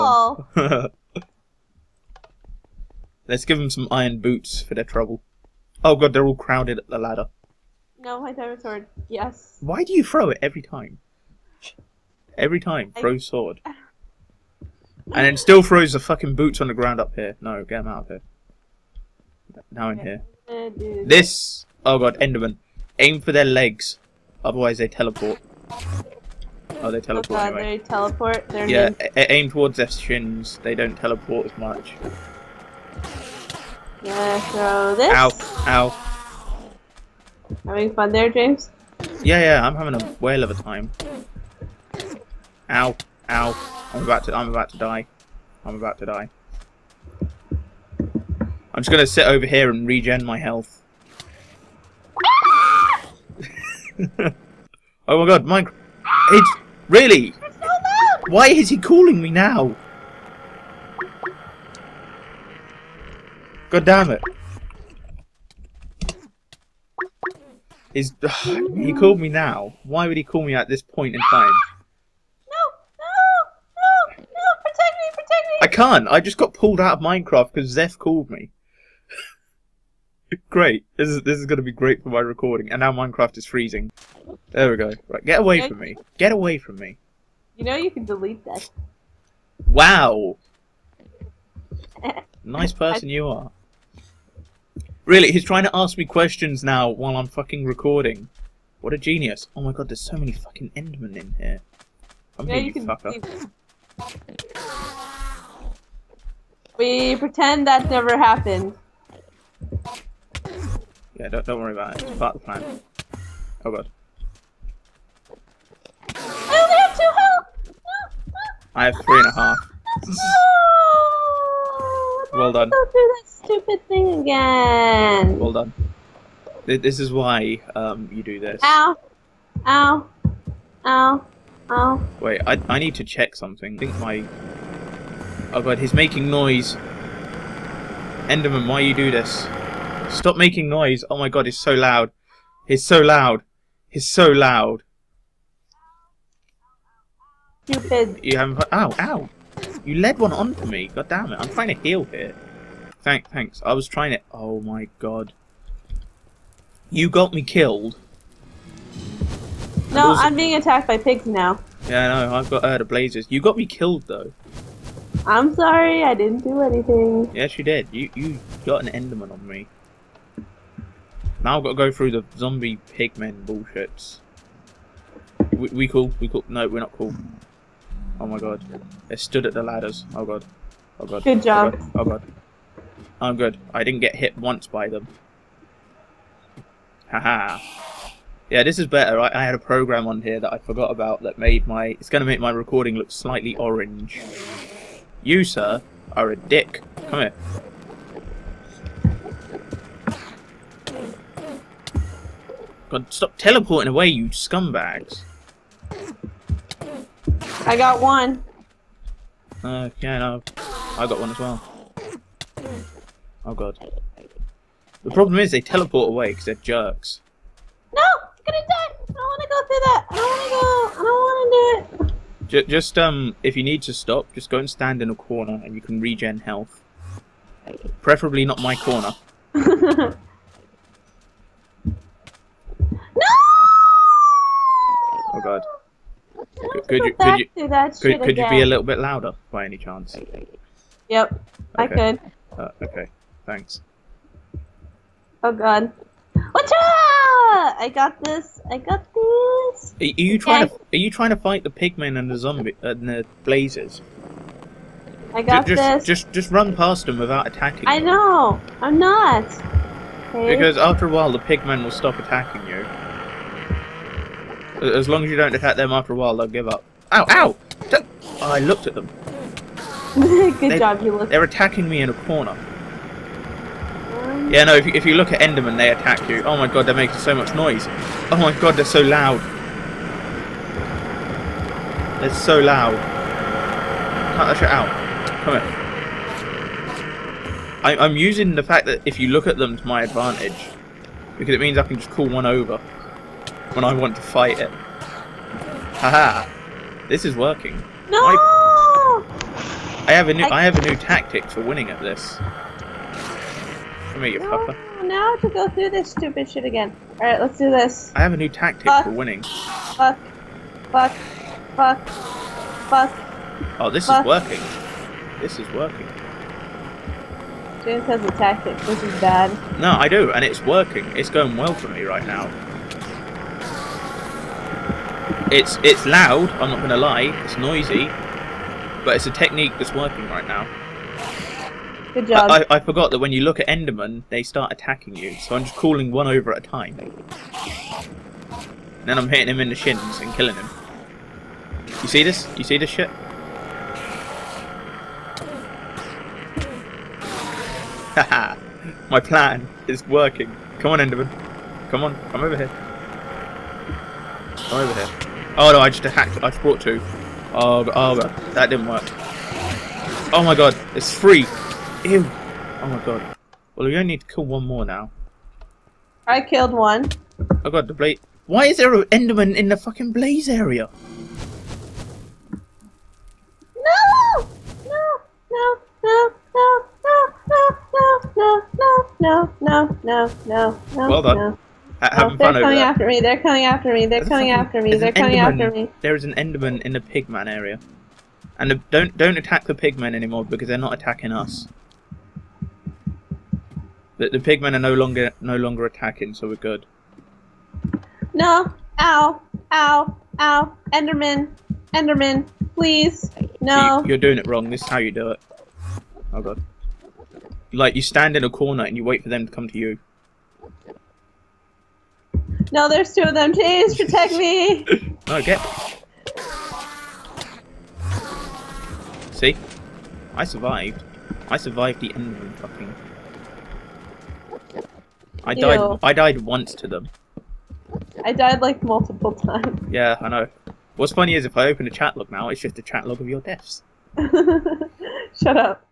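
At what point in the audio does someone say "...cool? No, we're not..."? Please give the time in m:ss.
2:56.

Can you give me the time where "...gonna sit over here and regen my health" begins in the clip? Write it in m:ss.
0:48.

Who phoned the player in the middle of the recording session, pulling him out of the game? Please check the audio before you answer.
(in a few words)
Zeph.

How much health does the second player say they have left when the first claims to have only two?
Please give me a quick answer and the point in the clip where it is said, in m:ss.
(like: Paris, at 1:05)
3.5, at 1:59.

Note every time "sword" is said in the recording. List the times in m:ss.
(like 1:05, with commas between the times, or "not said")
0:08, 0:13.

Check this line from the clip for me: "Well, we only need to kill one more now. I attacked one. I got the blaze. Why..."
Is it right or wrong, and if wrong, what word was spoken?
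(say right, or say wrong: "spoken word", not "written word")
wrong: "killed", not "attacked".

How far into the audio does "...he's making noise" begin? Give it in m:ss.
2:15.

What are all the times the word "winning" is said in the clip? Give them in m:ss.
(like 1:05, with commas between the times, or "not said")
5:01, 5:09.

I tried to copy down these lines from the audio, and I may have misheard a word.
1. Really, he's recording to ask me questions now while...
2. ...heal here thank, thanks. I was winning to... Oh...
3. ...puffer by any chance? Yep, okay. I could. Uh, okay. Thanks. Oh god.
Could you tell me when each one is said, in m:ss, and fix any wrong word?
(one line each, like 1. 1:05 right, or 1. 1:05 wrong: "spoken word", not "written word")
1. 1:35 wrong: "trying", not "recording"
2. 2:31 wrong: "trying", not "winning"
3. 3:58 wrong: "louder", not "puffer".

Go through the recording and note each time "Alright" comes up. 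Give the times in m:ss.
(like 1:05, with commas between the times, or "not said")
5:07.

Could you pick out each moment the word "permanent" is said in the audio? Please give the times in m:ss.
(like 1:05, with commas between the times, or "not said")
not said.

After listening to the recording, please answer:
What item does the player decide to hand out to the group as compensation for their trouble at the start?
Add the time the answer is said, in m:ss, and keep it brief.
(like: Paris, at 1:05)
Iron boots, at 0:03.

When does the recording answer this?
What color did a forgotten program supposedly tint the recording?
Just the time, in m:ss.
3:13.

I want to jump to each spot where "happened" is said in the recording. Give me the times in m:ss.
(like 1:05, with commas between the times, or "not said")
1:48.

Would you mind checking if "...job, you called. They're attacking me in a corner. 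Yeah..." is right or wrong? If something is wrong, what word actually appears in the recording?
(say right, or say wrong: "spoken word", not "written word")
wrong: "looked", not "called".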